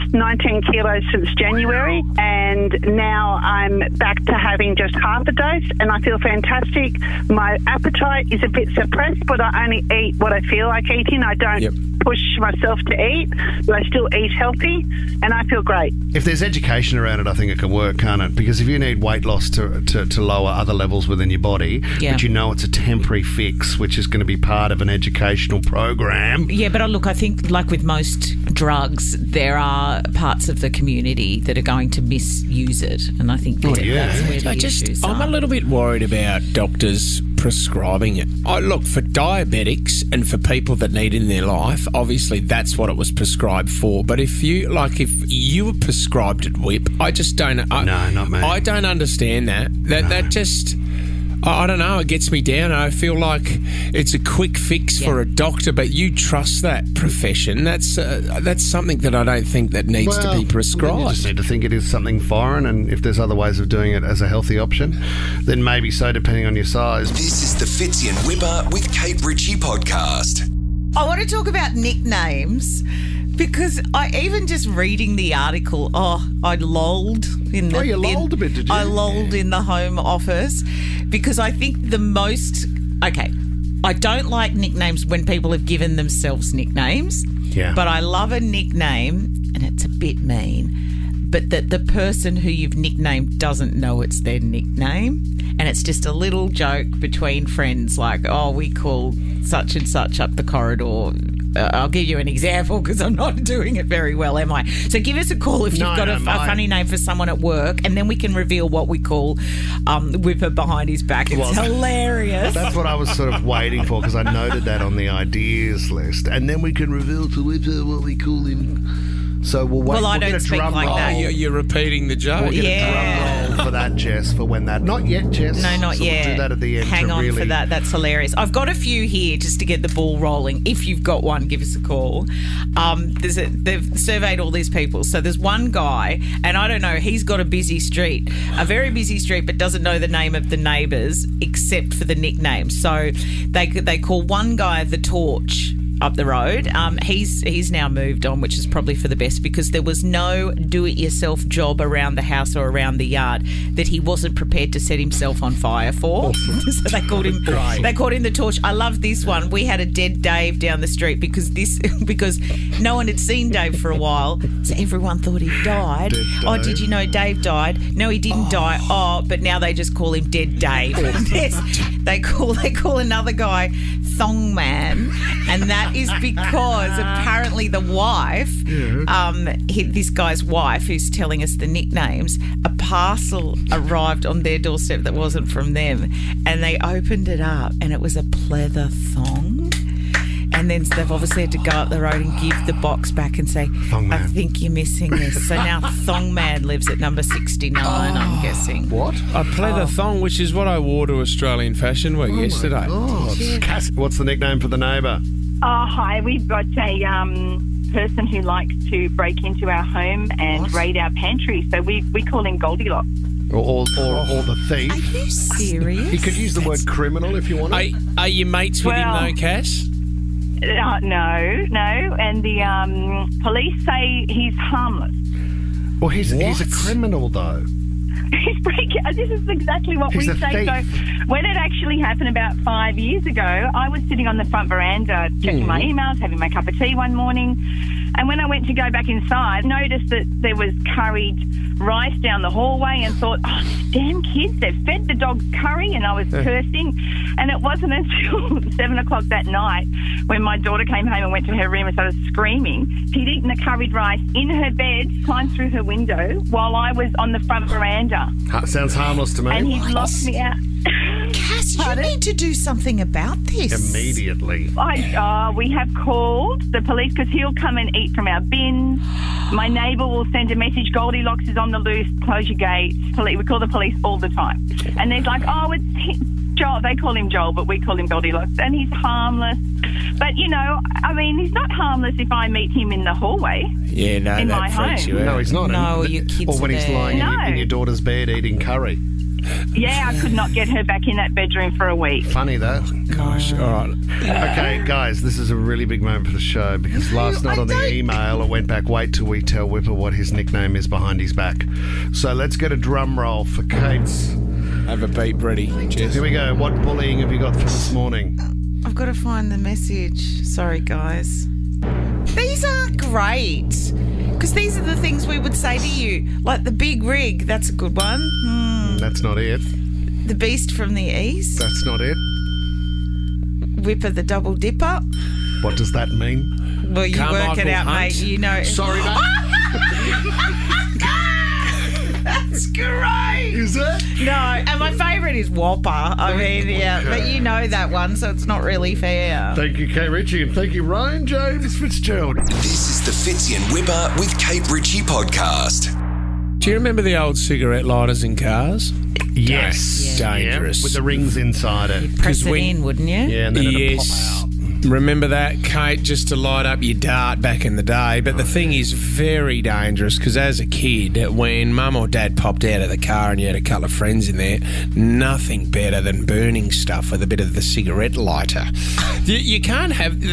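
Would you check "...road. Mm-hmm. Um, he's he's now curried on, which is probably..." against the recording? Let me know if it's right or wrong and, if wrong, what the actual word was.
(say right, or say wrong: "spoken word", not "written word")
wrong: "moved", not "curried".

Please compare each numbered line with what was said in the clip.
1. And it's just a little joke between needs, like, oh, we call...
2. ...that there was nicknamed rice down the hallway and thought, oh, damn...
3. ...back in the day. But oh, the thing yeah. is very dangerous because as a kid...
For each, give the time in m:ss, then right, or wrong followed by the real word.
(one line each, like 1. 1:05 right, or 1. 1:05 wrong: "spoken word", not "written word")
1. 1:35 wrong: "friends", not "needs"
2. 4:00 wrong: "curried", not "nicknamed"
3. 5:57 right.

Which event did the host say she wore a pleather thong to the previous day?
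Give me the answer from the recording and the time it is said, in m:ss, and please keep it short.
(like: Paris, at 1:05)
Australian Fashion Week, at 3:21.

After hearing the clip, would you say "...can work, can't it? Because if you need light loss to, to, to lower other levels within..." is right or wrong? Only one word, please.
wrong.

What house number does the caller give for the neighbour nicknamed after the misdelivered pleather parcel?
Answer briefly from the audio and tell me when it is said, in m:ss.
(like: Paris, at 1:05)
69, at 3:17.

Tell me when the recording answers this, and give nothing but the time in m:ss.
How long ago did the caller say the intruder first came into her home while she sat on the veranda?
3:52.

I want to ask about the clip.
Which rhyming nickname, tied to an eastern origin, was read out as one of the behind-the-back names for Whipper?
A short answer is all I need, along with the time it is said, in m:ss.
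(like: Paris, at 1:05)
The beast from the east, at 5:20.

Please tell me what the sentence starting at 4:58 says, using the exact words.
Wait till we tell Whipper what his nickname is behind his back.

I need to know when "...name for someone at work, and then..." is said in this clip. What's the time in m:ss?
1:46.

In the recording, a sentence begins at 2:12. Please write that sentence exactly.
Um, there's a, they've surveyed all these people.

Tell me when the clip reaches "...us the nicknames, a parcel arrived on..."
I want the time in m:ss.
3:01.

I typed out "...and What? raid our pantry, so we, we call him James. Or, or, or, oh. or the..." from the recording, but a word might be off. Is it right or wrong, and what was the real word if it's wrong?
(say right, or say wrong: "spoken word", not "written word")
wrong: "Goldilocks", not "James".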